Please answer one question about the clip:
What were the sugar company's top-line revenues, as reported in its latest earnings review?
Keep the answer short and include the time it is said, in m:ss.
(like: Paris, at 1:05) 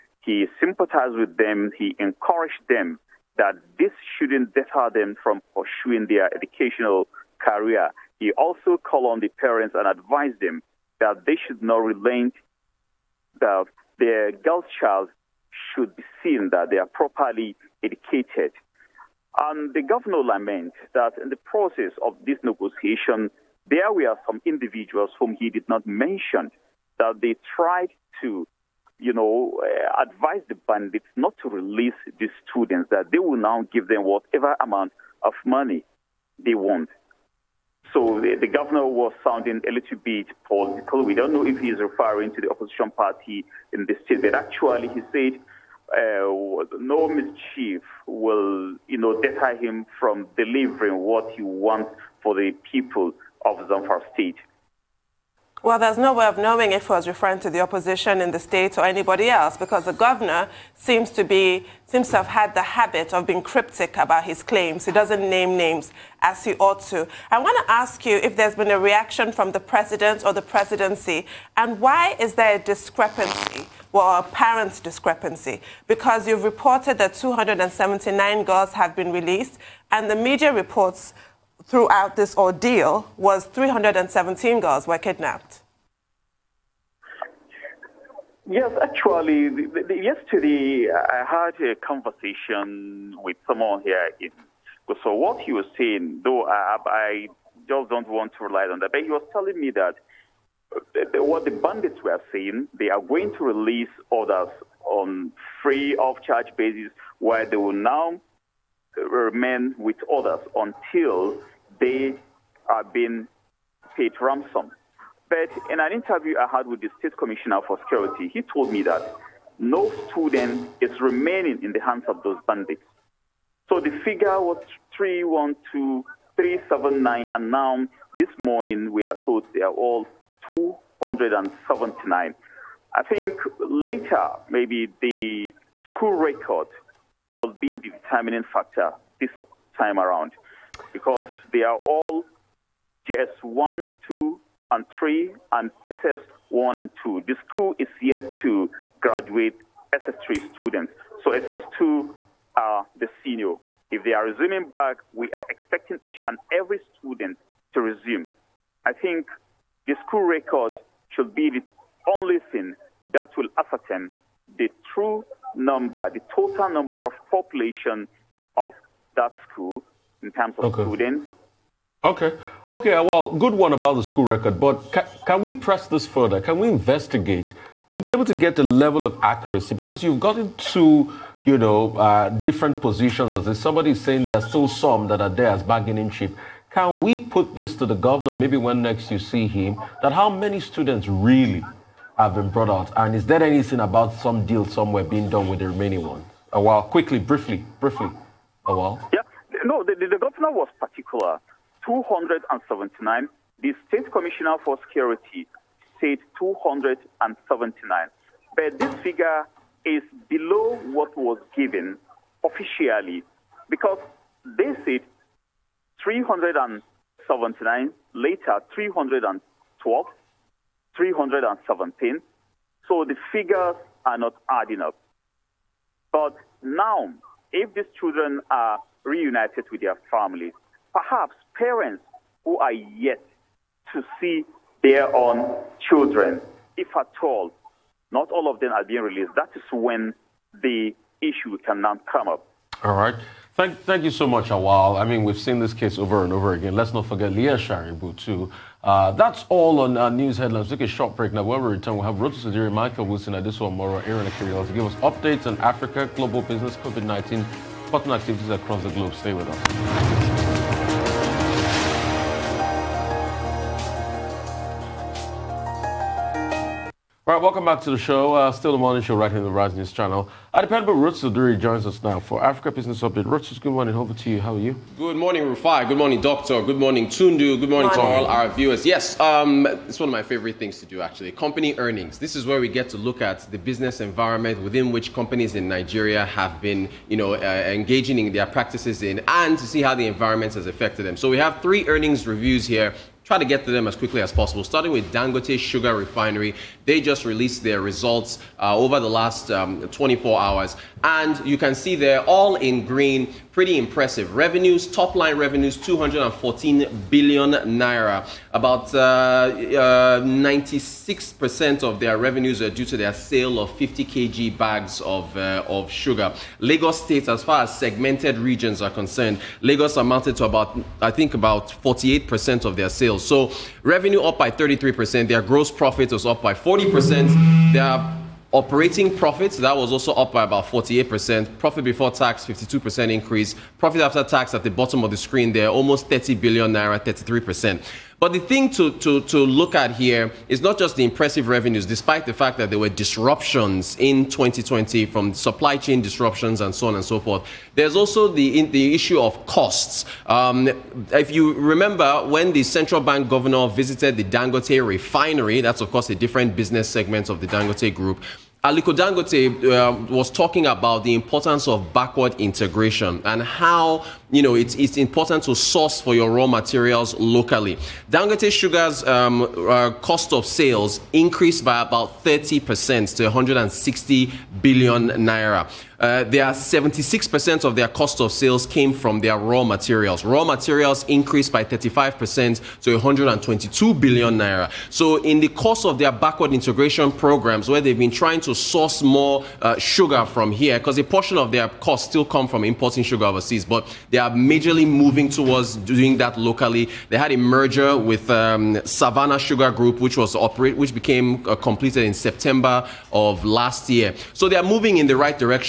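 214 billion naira, at 5:05.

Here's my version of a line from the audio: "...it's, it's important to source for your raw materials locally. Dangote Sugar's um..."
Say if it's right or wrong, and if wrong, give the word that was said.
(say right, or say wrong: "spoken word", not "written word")
right.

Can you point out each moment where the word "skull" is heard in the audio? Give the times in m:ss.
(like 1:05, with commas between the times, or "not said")
not said.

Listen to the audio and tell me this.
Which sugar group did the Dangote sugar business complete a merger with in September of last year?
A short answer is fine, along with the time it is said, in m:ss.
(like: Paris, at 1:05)
Savannah Sugar Group, at 6:38.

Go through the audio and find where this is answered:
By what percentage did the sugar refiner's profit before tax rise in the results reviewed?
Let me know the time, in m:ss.
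5:32.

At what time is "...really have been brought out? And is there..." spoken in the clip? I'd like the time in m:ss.
3:11.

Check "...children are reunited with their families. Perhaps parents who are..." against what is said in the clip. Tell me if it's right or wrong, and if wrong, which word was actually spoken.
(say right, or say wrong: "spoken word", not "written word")
right.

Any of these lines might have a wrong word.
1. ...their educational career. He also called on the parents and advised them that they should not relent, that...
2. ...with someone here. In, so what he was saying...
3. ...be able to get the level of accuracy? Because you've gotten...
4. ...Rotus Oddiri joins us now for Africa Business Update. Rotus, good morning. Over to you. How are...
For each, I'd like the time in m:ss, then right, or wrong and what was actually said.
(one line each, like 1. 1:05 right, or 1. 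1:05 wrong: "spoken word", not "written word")
1. 0:06 right
2. 1:33 right
3. 2:57 right
4. 4:30 right.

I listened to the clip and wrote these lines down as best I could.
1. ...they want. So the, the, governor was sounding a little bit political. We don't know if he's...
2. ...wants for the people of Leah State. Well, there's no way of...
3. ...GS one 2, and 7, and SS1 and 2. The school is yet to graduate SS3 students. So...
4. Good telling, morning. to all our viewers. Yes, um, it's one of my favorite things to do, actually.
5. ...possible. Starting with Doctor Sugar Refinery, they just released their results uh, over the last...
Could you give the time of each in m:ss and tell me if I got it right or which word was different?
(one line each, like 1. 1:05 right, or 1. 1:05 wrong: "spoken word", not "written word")
1. 0:36 right
2. 0:51 wrong: "Zamfara", not "Leah"
3. 2:23 wrong: "3", not "7"
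4. 4:37 wrong: "morning", not "telling"
5. 4:54 wrong: "Dangote", not "Doctor".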